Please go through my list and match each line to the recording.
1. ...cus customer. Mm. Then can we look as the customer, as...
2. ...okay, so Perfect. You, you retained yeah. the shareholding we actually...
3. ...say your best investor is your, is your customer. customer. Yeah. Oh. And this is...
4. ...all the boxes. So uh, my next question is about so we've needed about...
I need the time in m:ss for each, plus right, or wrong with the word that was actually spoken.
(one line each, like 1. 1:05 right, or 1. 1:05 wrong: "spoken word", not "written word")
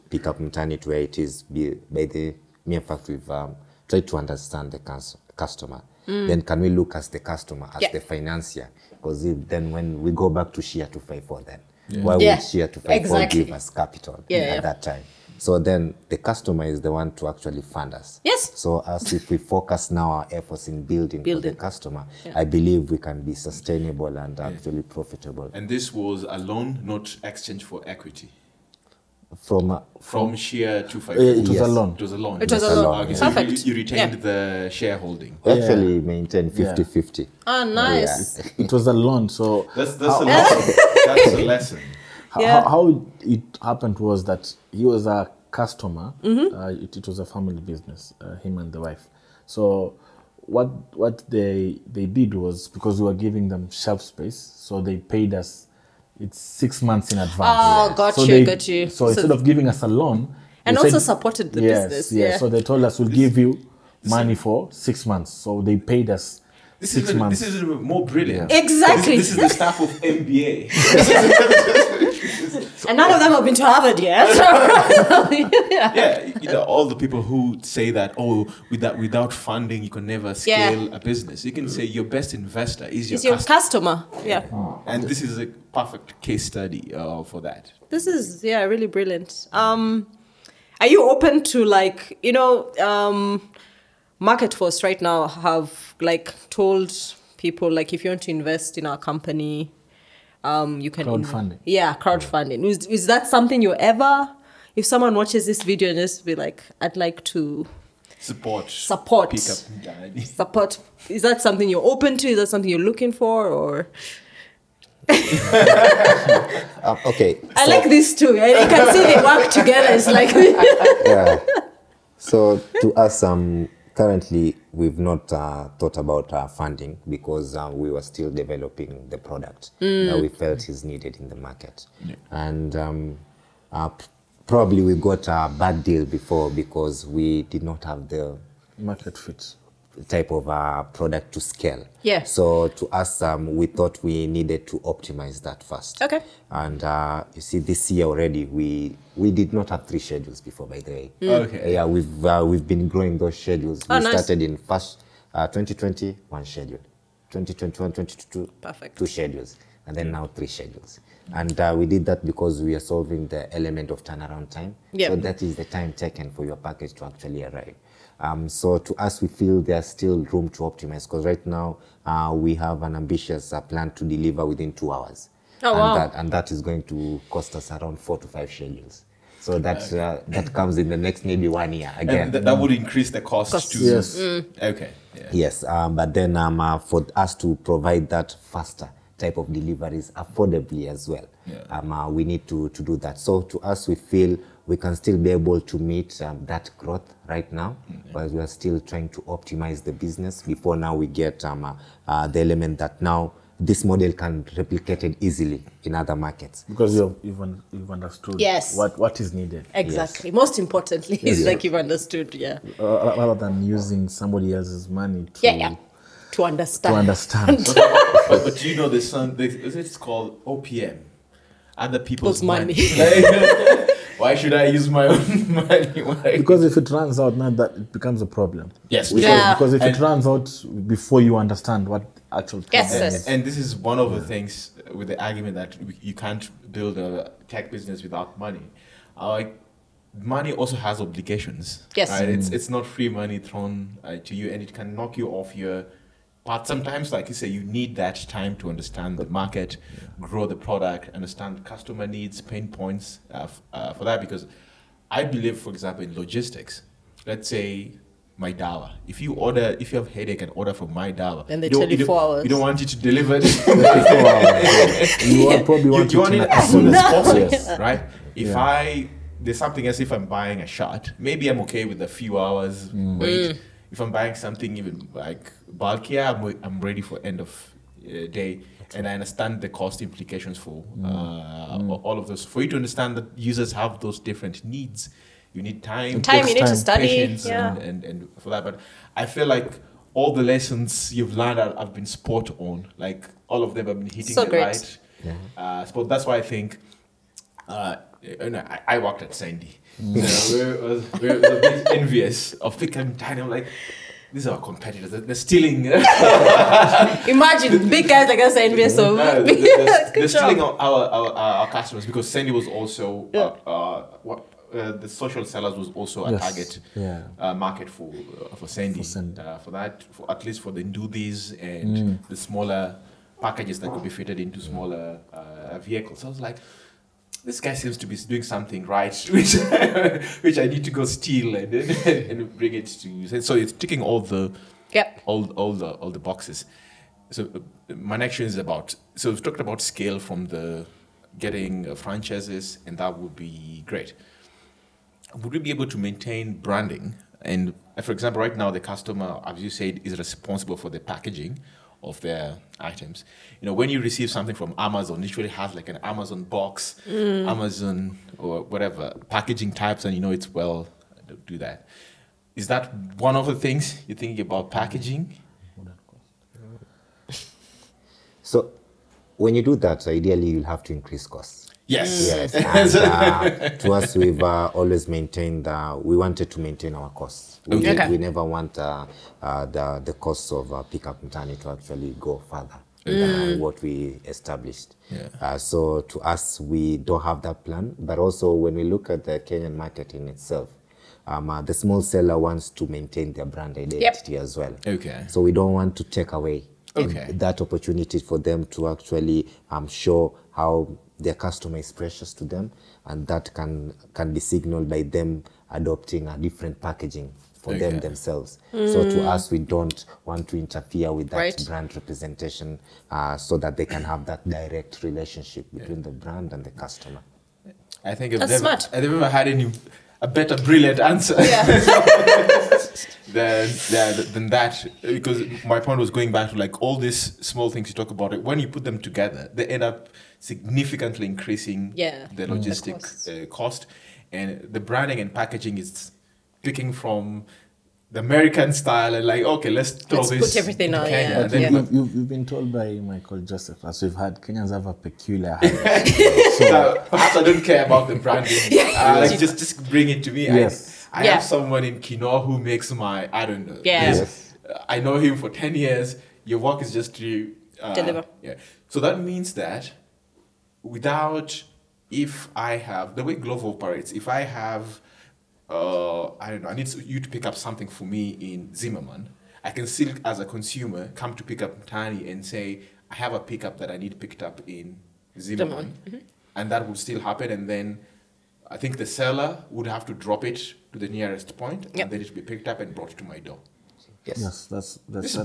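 1. 0:04 right
2. 0:33 right
3. 1:21 right
4. 5:36 wrong: "talked", not "needed".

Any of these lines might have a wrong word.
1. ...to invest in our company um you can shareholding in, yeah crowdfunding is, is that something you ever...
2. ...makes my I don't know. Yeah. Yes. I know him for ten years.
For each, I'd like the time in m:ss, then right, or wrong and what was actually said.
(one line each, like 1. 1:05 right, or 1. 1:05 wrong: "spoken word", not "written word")
1. 1:38 wrong: "crowdfunding", not "shareholding"
2. 7:32 right.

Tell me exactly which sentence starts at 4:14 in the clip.
Because I believe, for example, in logistics, let's say MyDawa.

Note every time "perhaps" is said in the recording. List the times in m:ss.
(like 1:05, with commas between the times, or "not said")
7:27.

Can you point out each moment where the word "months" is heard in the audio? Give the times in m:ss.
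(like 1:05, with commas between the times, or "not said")
0:56, 1:05.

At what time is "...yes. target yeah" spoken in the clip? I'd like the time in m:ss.
5:16.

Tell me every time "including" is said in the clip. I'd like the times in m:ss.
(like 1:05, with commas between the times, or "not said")
not said.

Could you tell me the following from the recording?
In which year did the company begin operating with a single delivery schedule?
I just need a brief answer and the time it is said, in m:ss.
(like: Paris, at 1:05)
2020, at 2:35.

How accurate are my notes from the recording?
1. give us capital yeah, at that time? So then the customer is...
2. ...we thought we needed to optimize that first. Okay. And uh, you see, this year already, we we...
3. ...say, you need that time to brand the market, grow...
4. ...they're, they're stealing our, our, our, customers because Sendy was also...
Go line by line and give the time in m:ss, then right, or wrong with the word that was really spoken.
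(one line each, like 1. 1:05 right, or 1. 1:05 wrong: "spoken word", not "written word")
1. 0:13 right
2. 2:23 right
3. 4:07 wrong: "understand", not "brand"
4. 5:09 right.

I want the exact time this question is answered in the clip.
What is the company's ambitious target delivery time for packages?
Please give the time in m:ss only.
2:54.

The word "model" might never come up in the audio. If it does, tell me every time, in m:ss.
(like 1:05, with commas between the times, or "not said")
3:23.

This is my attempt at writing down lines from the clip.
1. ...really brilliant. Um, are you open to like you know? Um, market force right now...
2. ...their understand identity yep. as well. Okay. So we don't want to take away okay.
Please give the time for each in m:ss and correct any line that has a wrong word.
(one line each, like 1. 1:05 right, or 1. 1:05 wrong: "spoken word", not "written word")
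1. 1:28 right
2. 6:33 wrong: "brand", not "understand".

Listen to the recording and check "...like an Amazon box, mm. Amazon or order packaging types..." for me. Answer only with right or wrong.
wrong.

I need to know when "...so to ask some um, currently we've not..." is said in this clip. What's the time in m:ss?
2:02.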